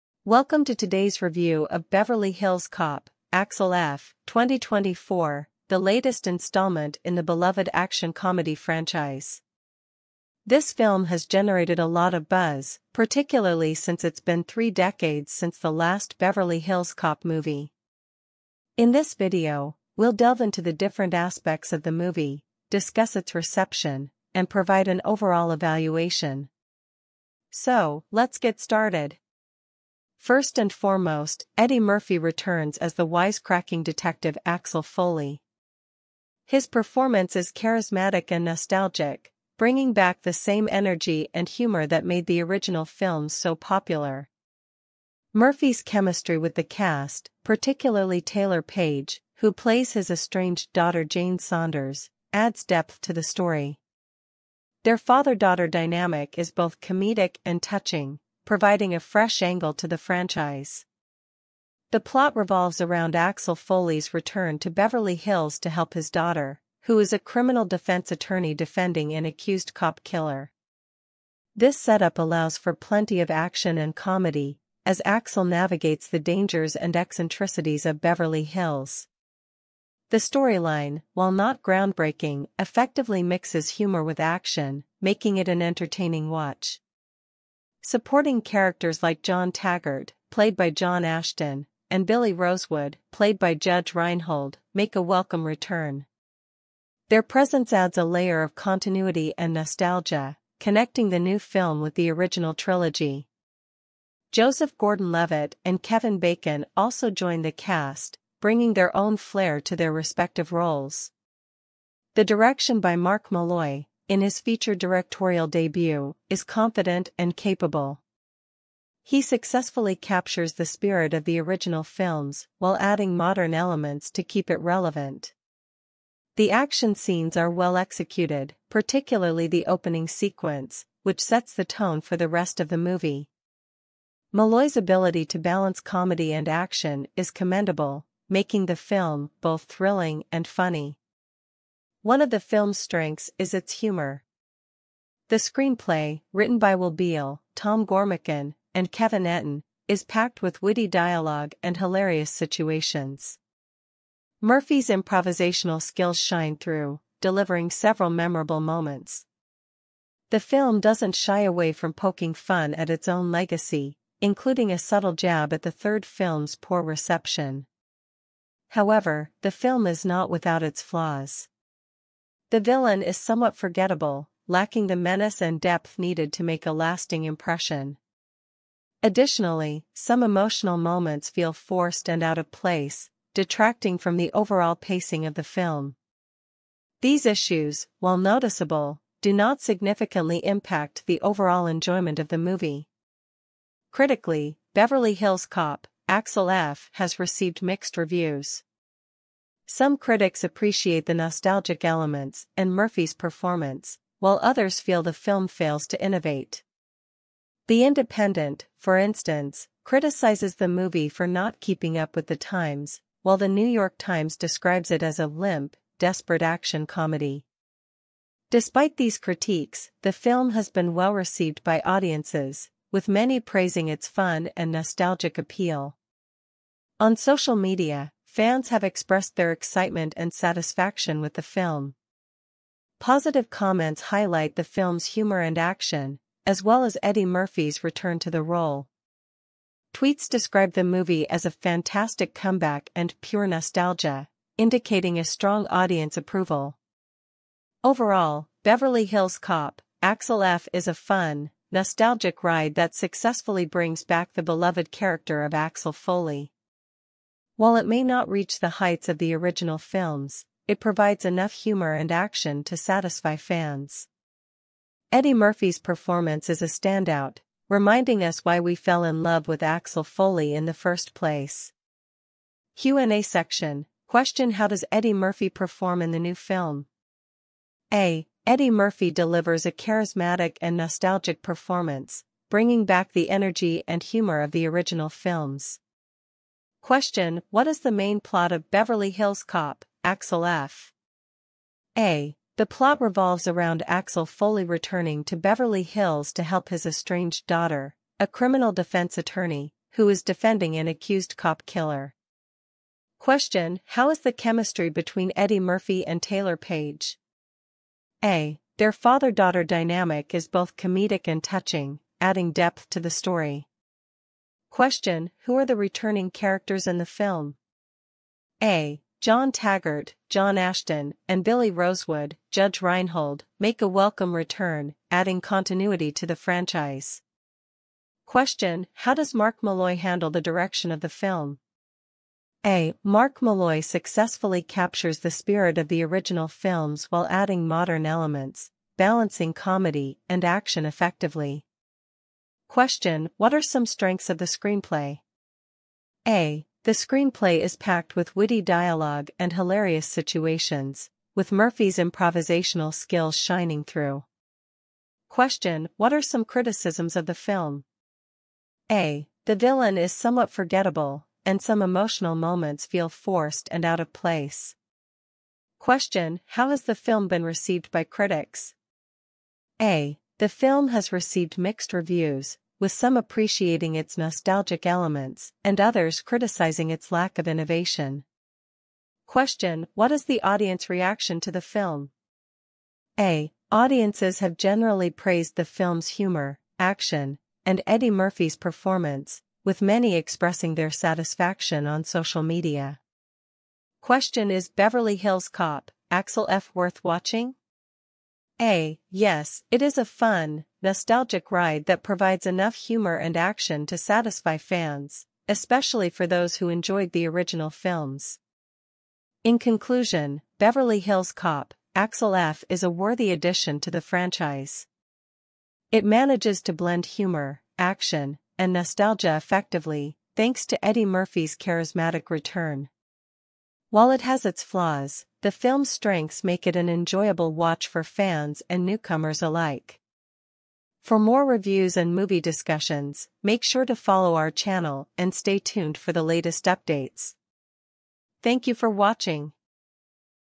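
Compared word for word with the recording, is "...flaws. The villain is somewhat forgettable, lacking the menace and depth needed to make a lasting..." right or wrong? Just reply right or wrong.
right.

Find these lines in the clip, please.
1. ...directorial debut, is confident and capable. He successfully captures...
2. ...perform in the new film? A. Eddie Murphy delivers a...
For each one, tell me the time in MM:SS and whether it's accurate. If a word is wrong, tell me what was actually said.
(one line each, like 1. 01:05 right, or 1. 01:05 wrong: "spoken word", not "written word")
1. 01:54 right
2. 04:35 right.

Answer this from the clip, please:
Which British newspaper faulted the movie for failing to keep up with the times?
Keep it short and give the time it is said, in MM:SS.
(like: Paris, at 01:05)
The Independent, at 03:27.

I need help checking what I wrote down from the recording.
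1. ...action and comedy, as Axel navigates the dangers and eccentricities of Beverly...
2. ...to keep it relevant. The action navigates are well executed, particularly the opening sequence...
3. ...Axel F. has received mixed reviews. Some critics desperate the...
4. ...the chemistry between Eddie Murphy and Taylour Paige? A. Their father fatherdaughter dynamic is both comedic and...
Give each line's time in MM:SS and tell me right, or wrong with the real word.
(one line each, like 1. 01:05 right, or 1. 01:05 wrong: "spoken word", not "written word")
1. 01:13 right
2. 02:04 wrong: "scenes", not "navigates"
3. 03:16 wrong: "appreciate", not "desperate"
4. 05:04 wrong: "daughter", not "fatherdaughter".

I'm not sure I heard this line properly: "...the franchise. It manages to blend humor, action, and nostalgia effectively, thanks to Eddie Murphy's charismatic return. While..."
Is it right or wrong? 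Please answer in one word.
right.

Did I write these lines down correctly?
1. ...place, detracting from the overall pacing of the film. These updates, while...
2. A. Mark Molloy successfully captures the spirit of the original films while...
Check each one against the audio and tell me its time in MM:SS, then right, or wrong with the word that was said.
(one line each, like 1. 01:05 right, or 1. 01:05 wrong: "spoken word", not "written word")
1. 03:02 wrong: "issues", not "updates"
2. 05:32 right.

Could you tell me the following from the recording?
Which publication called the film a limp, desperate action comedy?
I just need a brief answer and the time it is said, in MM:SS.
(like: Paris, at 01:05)
New York Times, at 03:33.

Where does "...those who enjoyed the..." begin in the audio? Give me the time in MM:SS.
06:46.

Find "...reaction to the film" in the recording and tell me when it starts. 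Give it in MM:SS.
06:20.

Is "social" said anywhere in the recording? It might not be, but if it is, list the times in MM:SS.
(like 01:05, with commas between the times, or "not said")
03:47, 06:32.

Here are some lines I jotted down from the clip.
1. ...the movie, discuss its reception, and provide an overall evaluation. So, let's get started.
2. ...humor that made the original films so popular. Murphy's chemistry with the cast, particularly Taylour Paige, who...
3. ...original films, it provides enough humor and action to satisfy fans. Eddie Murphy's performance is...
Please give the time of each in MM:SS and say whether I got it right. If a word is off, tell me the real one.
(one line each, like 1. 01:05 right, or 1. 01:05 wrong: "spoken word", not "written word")
1. 00:21 right
2. 00:41 right
3. 04:19 right.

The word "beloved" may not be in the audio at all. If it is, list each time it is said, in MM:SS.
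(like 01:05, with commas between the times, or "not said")
00:07, 04:14.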